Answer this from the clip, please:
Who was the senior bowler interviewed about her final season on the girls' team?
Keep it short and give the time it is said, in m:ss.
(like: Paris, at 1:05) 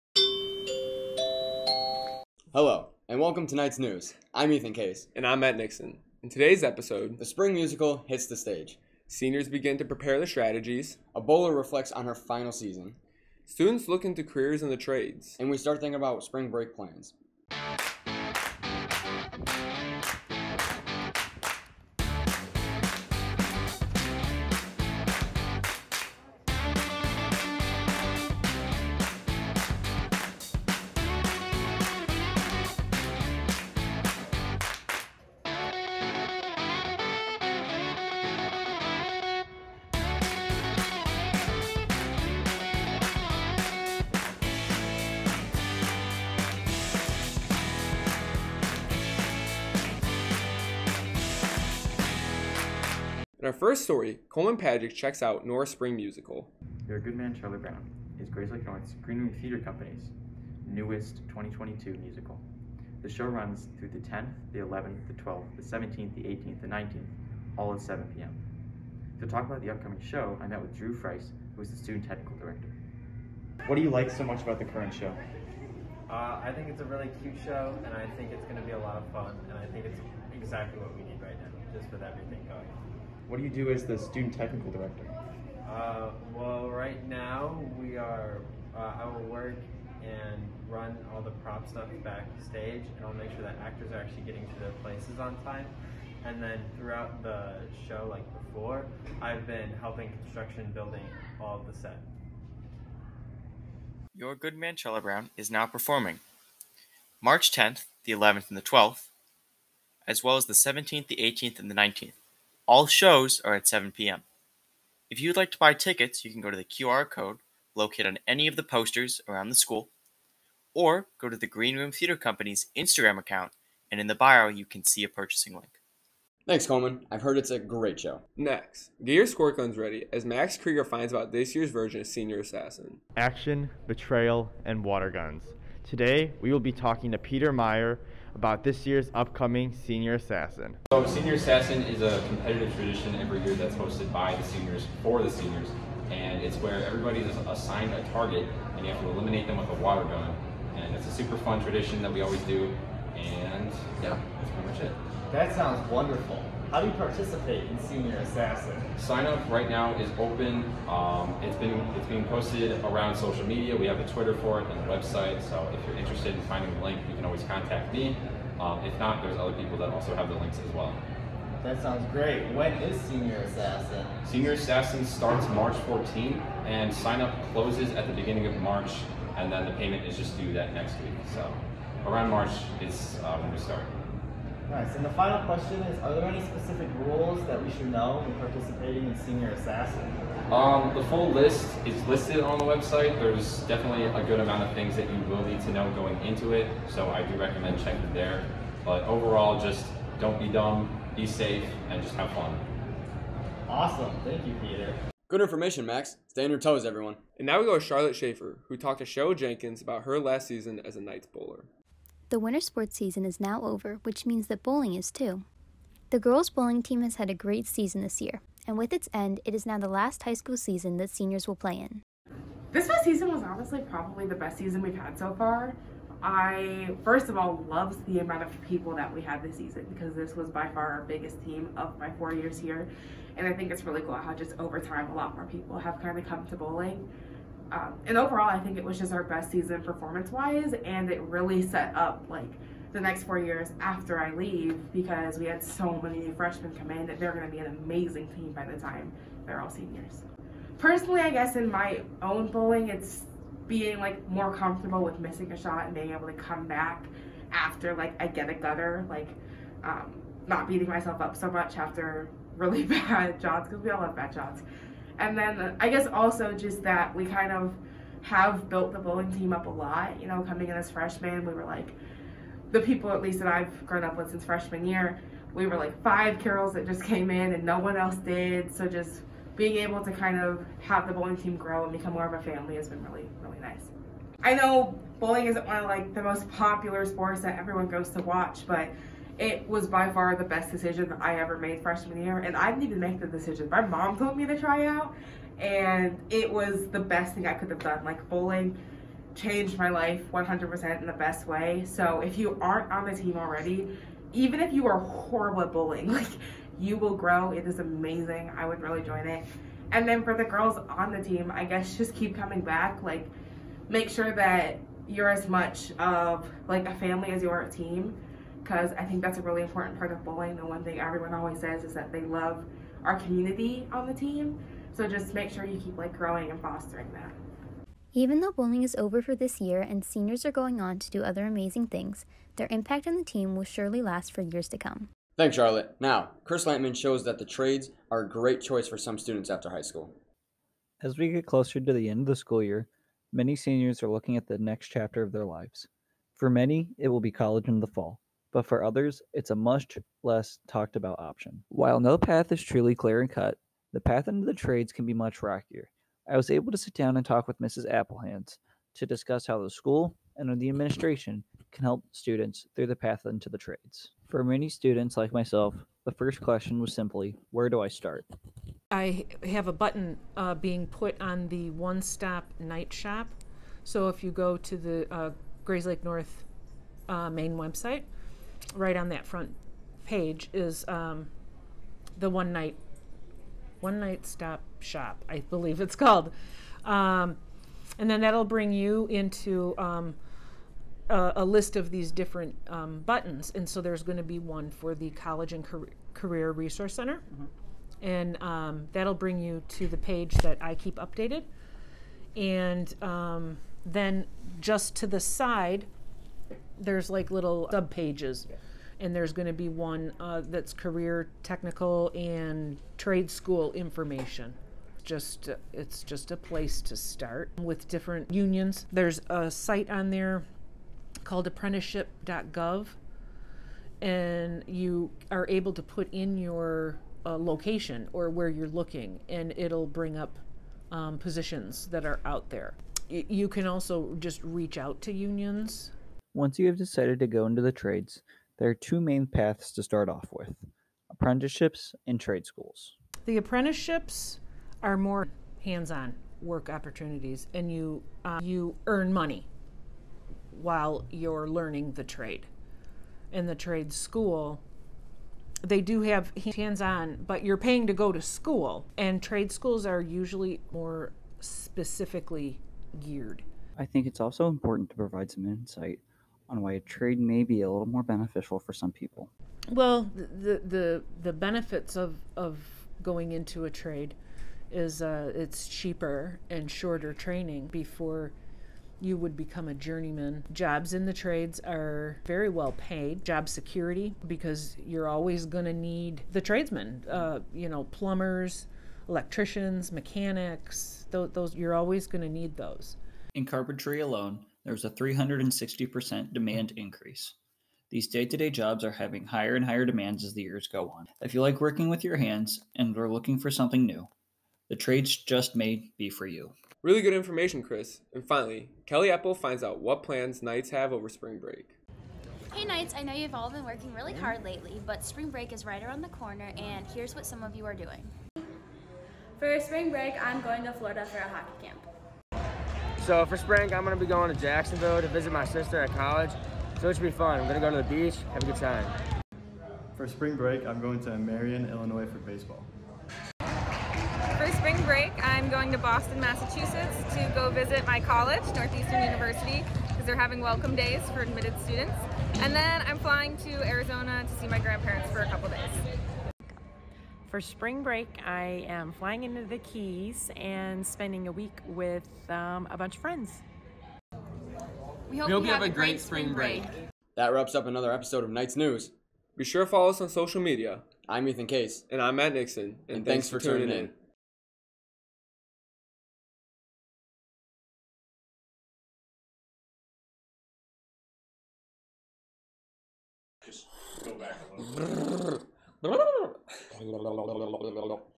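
Cheryl Jenkins, at 3:29.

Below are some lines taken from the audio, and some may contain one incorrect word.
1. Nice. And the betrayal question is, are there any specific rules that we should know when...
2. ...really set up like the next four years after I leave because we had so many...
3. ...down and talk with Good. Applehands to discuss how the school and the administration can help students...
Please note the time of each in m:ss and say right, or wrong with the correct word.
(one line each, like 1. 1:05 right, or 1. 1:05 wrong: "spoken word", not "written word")
1. 3:04 wrong: "final", not "betrayal"
2. 4:01 right
3. 5:56 wrong: "Mrs", not "Good".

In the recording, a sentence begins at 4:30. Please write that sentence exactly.
You know, coming in as freshmen, we were like the people at least that I've grown up with since freshman year.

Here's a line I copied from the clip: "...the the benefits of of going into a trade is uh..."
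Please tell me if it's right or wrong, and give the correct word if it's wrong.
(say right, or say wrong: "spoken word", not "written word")
right.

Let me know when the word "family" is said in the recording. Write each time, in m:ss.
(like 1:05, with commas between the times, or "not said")
4:42, 5:16.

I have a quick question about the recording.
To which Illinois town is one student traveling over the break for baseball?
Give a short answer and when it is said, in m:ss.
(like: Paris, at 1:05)
Marion, at 8:51.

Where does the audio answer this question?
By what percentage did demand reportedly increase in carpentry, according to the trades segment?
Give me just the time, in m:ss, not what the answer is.
8:14.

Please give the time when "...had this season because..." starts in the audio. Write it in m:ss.
3:49.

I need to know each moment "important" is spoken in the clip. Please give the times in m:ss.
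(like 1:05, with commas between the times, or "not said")
5:19, 7:44.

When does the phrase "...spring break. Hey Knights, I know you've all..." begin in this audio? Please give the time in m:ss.
8:31.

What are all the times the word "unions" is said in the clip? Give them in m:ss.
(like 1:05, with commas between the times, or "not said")
6:58, 7:15.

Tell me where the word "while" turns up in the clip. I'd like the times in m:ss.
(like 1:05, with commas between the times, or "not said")
5:51, 7:30.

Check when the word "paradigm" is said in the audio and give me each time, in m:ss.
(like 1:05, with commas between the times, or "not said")
not said.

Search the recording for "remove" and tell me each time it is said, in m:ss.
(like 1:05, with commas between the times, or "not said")
not said.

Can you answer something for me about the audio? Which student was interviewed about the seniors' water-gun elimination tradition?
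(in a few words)
Peter Meyer.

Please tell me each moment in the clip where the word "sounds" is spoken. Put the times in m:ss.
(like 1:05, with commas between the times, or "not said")
2:35, 2:51.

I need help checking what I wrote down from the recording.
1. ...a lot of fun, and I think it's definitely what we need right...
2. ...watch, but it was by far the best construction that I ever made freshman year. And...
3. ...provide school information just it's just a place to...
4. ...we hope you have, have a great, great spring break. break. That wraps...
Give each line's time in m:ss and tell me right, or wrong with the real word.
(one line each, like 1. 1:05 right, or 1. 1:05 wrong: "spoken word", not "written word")
1. 1:18 wrong: "exactly", not "definitely"
2. 4:48 wrong: "decision", not "construction"
3. 6:52 wrong: "trade", not "provide"
4. 9:15 right.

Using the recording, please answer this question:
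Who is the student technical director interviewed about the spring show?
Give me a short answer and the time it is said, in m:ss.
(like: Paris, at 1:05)
Drew Freis, at 1:10.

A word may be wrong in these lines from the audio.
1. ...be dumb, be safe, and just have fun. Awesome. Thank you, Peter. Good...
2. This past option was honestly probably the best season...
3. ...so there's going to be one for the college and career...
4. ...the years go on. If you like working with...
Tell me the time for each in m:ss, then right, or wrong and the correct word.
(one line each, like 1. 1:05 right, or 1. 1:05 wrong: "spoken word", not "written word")
1. 3:20 right
2. 3:42 wrong: "season", not "option"
3. 6:33 right
4. 8:20 right.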